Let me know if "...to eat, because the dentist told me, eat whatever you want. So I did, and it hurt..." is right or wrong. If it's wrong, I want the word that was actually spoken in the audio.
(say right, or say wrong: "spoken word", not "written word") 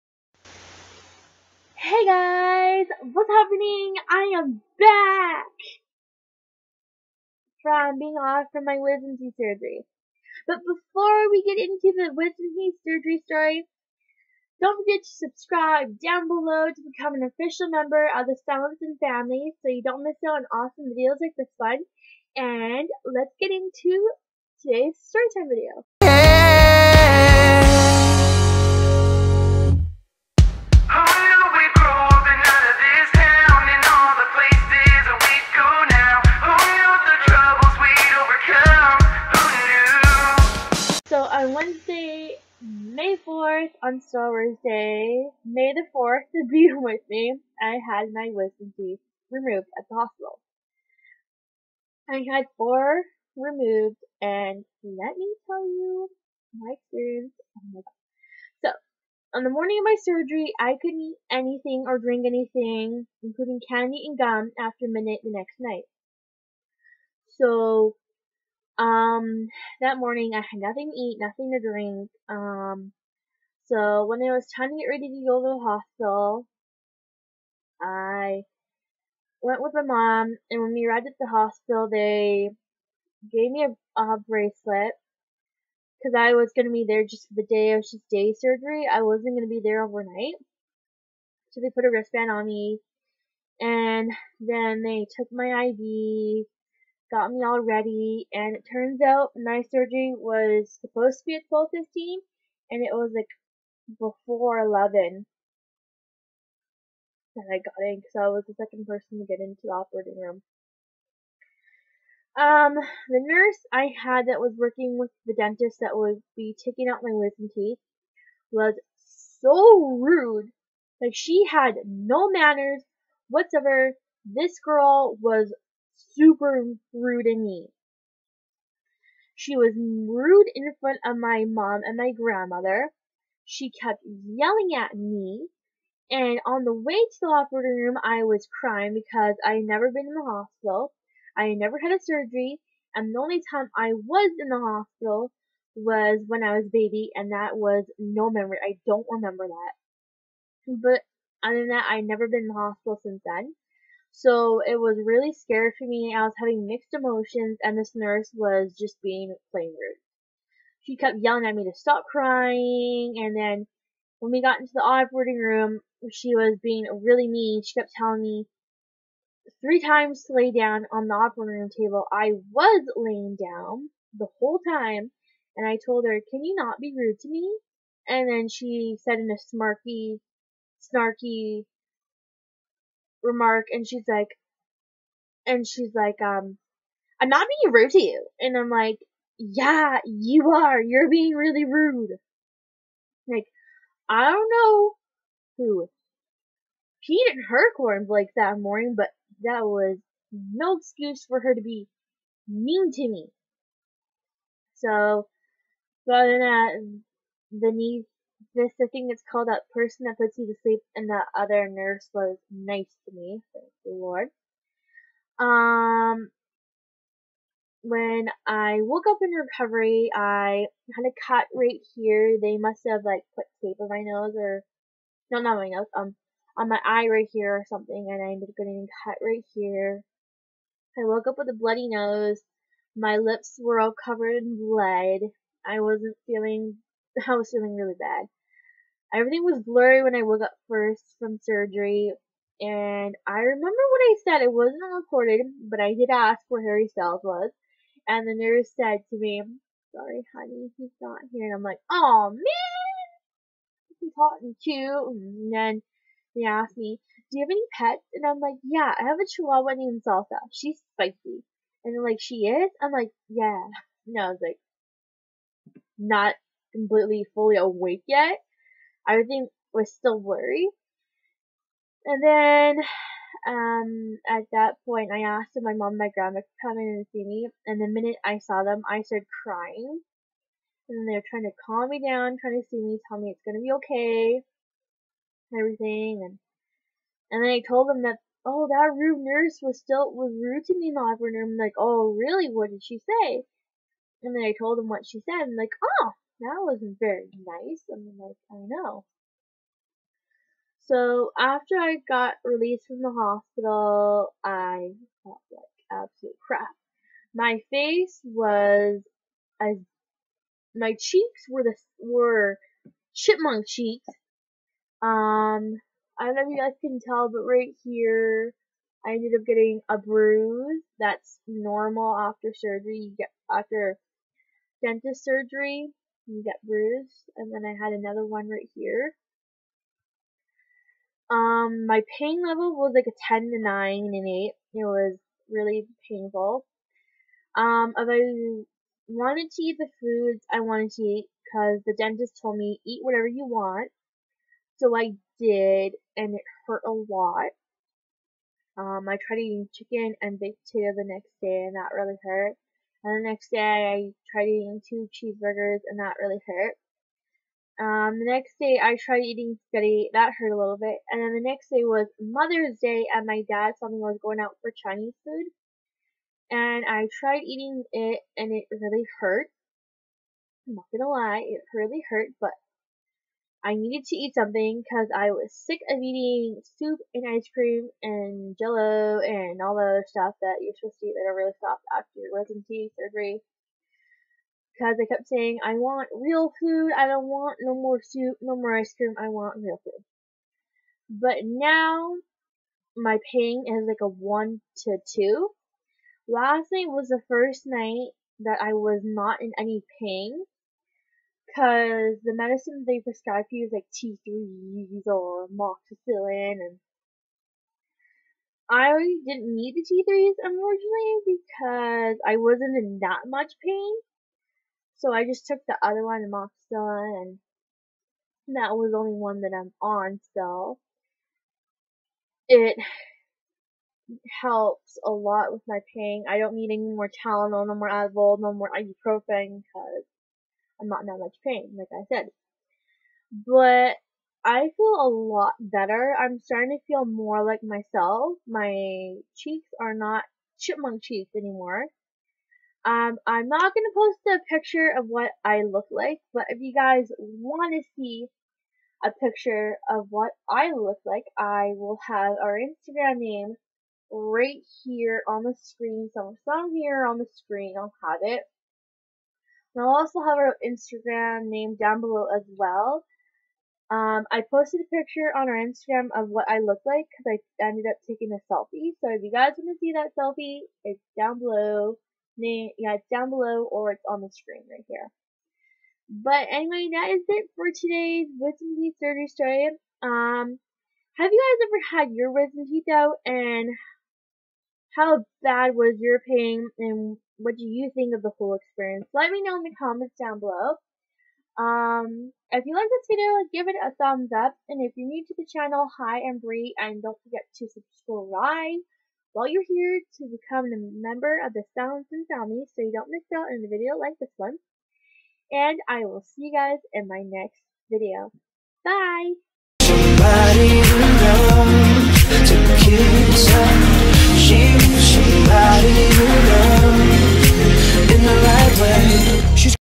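right.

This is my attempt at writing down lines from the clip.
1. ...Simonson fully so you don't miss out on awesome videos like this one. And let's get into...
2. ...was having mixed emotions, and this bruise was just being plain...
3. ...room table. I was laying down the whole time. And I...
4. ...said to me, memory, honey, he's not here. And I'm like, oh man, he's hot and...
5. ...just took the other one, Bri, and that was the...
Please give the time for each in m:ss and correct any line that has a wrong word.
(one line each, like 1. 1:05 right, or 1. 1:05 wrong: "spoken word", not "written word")
1. 0:18 wrong: "family", not "fully"
2. 2:36 wrong: "nurse", not "bruise"
3. 2:51 right
4. 4:08 wrong: "sorry", not "memory"
5. 6:55 wrong: "Amoxicillin", not "Bri".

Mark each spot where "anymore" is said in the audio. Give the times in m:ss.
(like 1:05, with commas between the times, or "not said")
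7:21.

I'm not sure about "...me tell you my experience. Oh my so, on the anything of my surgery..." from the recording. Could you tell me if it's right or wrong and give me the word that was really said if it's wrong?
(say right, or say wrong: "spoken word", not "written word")
wrong: "morning", not "anything".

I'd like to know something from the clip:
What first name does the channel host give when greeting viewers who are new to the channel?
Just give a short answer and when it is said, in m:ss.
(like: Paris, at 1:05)
Bri, at 8:16.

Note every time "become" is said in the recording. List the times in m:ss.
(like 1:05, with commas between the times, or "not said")
0:16, 8:20.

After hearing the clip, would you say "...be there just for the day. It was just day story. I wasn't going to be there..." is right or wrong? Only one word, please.
wrong.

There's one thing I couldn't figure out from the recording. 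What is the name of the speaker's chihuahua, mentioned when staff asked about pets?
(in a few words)
Salsa.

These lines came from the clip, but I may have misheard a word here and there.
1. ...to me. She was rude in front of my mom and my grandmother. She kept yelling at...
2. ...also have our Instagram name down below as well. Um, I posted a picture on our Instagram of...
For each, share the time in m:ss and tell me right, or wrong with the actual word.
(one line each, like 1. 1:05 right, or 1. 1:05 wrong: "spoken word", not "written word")
1. 2:07 right
2. 7:39 right.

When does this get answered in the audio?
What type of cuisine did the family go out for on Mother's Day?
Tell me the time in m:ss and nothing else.
6:04.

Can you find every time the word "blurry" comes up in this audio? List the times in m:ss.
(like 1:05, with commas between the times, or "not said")
3:59, 4:30.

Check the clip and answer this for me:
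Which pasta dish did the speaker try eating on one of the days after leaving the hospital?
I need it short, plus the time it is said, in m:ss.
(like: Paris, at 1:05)
Spaghetti, at 5:59.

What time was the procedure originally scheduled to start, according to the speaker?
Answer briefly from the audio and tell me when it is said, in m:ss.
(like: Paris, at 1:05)
12:15, at 1:41.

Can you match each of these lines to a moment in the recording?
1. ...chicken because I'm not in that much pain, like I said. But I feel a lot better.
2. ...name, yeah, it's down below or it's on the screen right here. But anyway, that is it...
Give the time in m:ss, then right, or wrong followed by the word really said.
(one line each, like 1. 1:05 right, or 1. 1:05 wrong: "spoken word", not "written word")
1. 7:08 wrong: "ibuprofen", not "chicken"
2. 7:52 right.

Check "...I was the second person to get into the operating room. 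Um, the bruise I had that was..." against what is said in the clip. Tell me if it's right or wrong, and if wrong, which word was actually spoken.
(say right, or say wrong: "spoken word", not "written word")
wrong: "nurse", not "bruise".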